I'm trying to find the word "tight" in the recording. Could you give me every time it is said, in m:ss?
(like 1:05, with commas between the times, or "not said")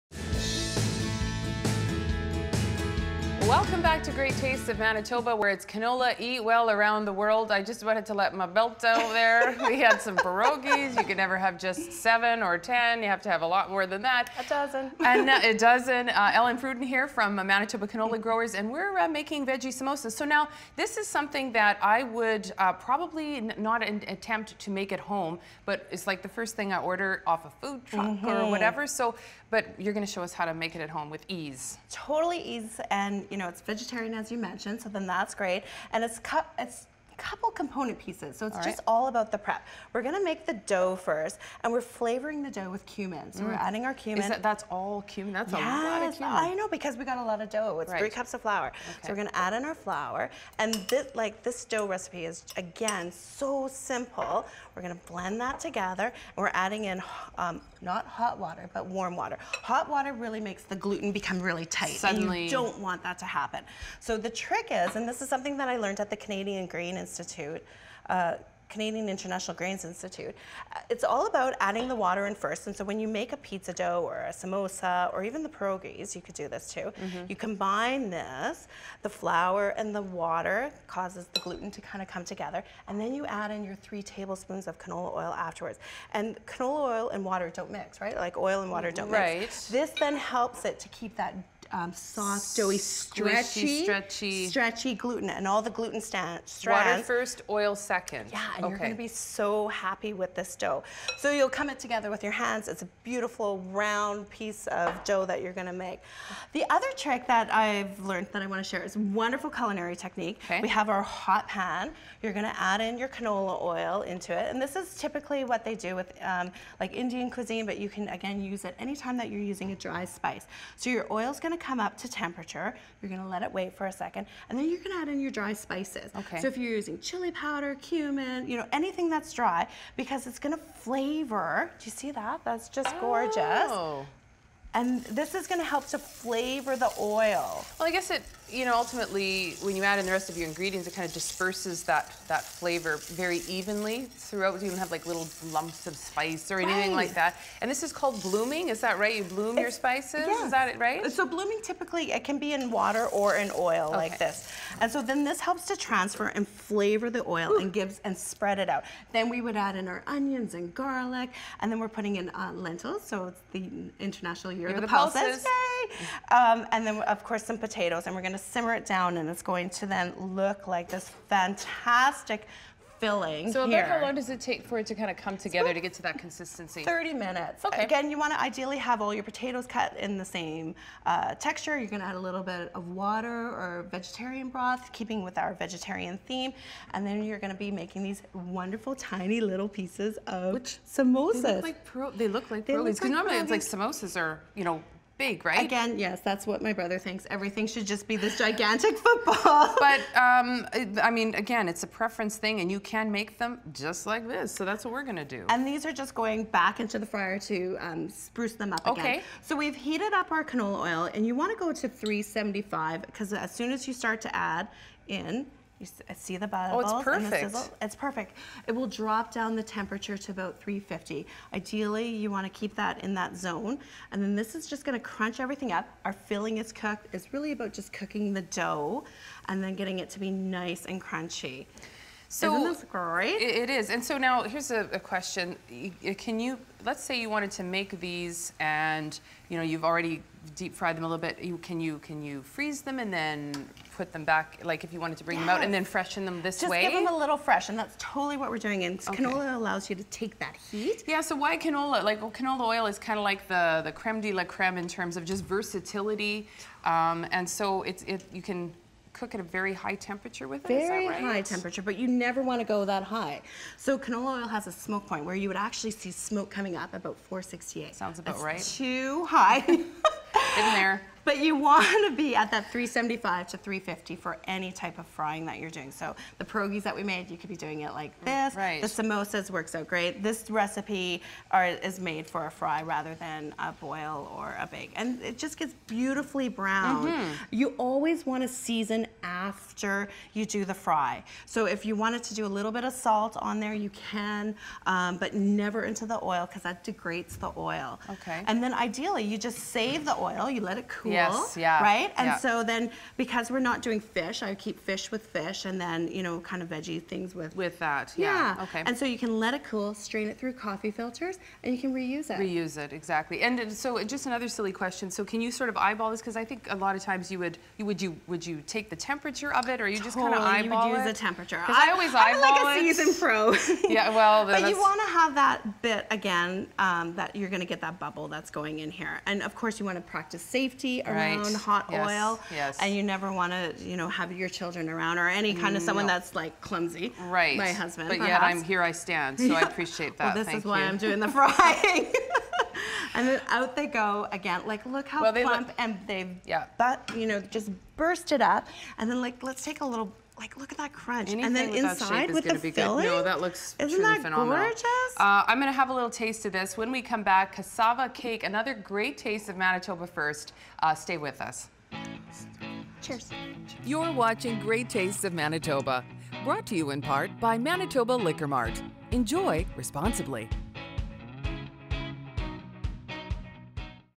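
1:01.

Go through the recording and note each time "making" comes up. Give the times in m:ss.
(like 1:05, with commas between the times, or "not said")
0:19, 3:07.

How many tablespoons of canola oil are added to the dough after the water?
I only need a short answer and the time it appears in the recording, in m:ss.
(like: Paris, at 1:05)
3, at 1:23.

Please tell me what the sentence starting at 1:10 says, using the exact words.
Uh, it's all about adding the water in first.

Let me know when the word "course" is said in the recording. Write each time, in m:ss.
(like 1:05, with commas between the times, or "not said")
2:47, 5:29.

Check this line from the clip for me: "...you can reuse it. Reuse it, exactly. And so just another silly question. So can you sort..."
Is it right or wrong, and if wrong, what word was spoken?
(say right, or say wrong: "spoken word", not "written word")
right.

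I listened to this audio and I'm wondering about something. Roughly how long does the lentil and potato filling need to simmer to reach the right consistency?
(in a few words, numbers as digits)
30 minutes.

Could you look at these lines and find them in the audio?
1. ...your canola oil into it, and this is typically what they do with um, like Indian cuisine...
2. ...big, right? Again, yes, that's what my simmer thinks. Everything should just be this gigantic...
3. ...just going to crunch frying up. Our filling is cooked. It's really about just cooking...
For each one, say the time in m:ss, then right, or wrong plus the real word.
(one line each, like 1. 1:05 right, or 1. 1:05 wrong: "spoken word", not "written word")
1. 1:52 right
2. 3:15 wrong: "brother", not "simmer"
3. 3:44 wrong: "everything", not "frying".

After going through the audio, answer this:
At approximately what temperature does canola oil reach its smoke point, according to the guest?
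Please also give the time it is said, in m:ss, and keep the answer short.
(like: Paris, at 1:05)
468, at 4:27.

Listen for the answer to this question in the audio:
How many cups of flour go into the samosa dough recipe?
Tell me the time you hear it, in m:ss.
0:47.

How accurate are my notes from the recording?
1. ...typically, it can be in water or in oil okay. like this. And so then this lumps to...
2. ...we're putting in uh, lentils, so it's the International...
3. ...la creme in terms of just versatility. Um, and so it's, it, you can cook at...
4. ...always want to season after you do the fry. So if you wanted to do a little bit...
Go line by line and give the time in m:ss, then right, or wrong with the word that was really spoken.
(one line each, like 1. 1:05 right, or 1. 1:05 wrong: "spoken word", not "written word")
1. 2:31 wrong: "helps", not "lumps"
2. 2:41 right
3. 4:14 right
4. 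4:47 right.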